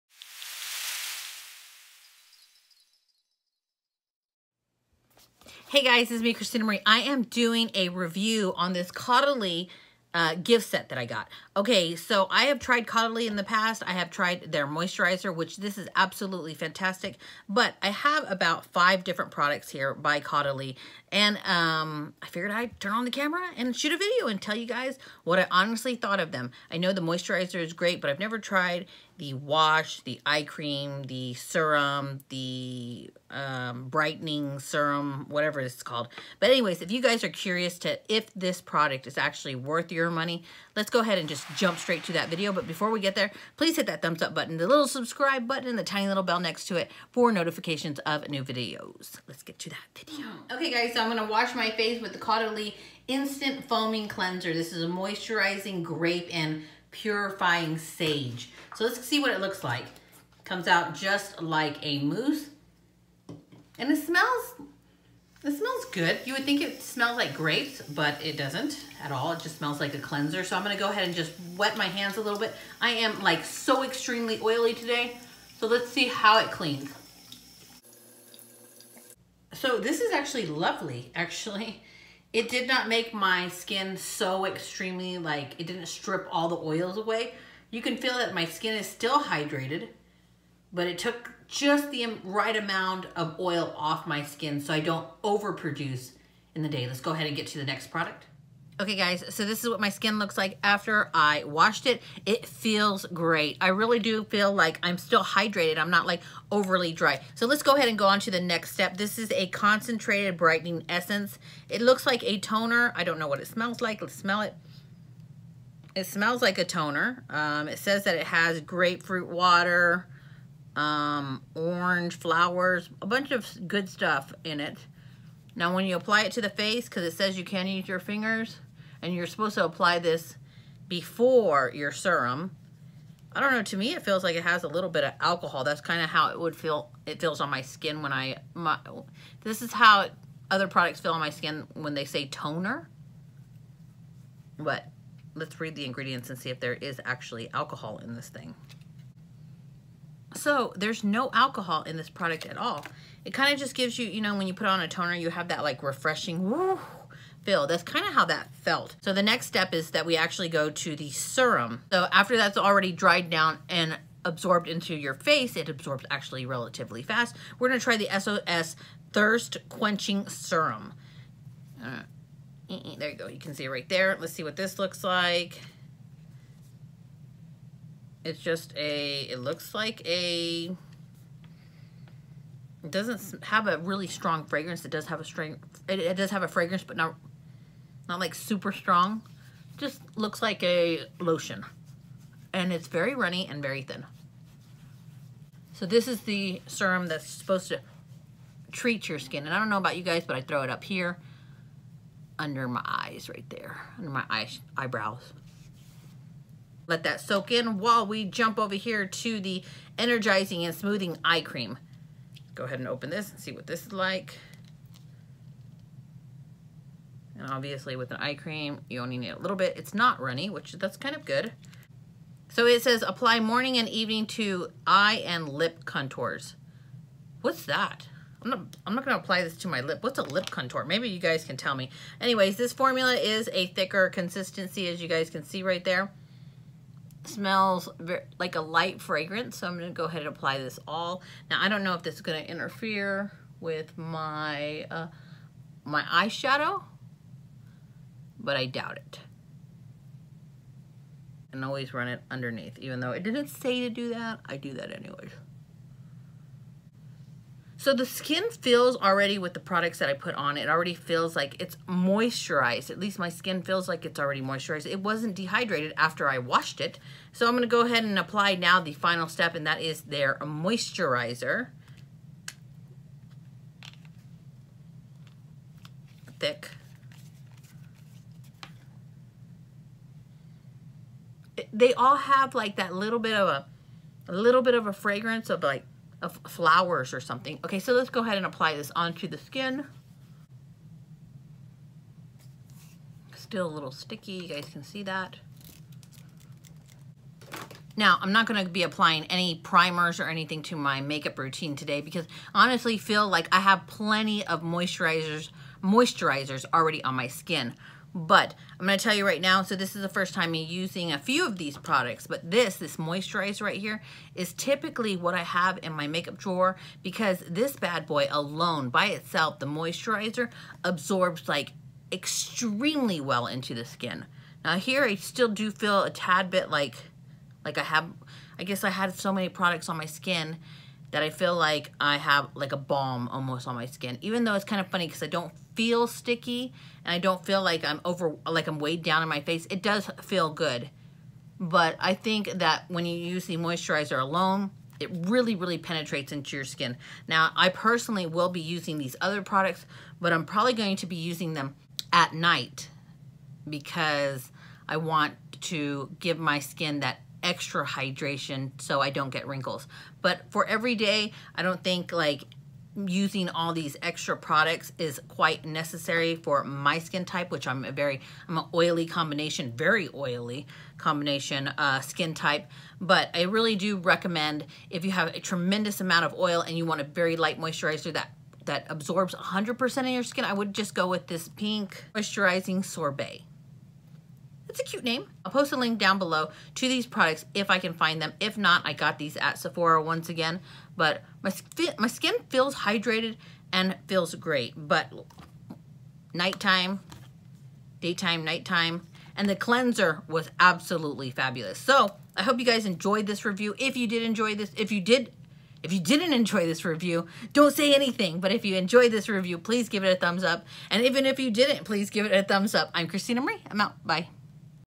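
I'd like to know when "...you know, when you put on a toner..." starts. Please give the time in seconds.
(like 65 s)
154 s.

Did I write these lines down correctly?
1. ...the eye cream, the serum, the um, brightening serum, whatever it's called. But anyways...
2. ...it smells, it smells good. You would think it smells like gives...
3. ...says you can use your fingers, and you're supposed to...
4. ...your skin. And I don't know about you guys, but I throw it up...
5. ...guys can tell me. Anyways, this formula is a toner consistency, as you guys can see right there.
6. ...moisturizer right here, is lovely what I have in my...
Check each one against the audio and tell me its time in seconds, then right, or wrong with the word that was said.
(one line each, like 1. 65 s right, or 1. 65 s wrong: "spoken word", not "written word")
1. 30 s right
2. 63 s wrong: "grapes", not "gives"
3. 127 s right
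4. 199 s right
5. 231 s wrong: "thicker", not "toner"
6. 312 s wrong: "typically", not "lovely".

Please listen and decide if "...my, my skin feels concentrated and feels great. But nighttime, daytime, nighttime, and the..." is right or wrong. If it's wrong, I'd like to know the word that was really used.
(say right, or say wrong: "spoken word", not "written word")
wrong: "hydrated", not "concentrated".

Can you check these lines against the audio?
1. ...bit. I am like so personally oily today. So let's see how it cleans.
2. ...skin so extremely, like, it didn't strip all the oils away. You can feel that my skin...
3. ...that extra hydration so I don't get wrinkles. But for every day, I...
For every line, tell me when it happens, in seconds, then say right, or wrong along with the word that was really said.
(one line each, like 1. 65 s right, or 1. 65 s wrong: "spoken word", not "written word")
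1. 72 s wrong: "extremely", not "personally"
2. 83 s right
3. 357 s right.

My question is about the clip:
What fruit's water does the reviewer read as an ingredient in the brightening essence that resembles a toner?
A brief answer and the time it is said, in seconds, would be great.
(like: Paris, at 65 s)
grapefruit, at 118 s.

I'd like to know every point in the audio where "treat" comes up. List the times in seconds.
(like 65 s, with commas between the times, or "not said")
198 s.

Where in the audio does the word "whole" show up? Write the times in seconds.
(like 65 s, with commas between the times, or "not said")
not said.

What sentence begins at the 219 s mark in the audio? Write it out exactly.
It's not runny, which that's kind of good.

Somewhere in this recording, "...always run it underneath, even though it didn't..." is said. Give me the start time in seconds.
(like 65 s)
251 s.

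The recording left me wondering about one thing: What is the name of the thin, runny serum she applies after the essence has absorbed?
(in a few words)
SOS Thirst Quenching Serum.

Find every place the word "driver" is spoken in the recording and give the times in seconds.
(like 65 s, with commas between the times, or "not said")
not said.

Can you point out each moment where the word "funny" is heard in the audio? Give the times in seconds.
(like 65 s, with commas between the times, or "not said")
334 s.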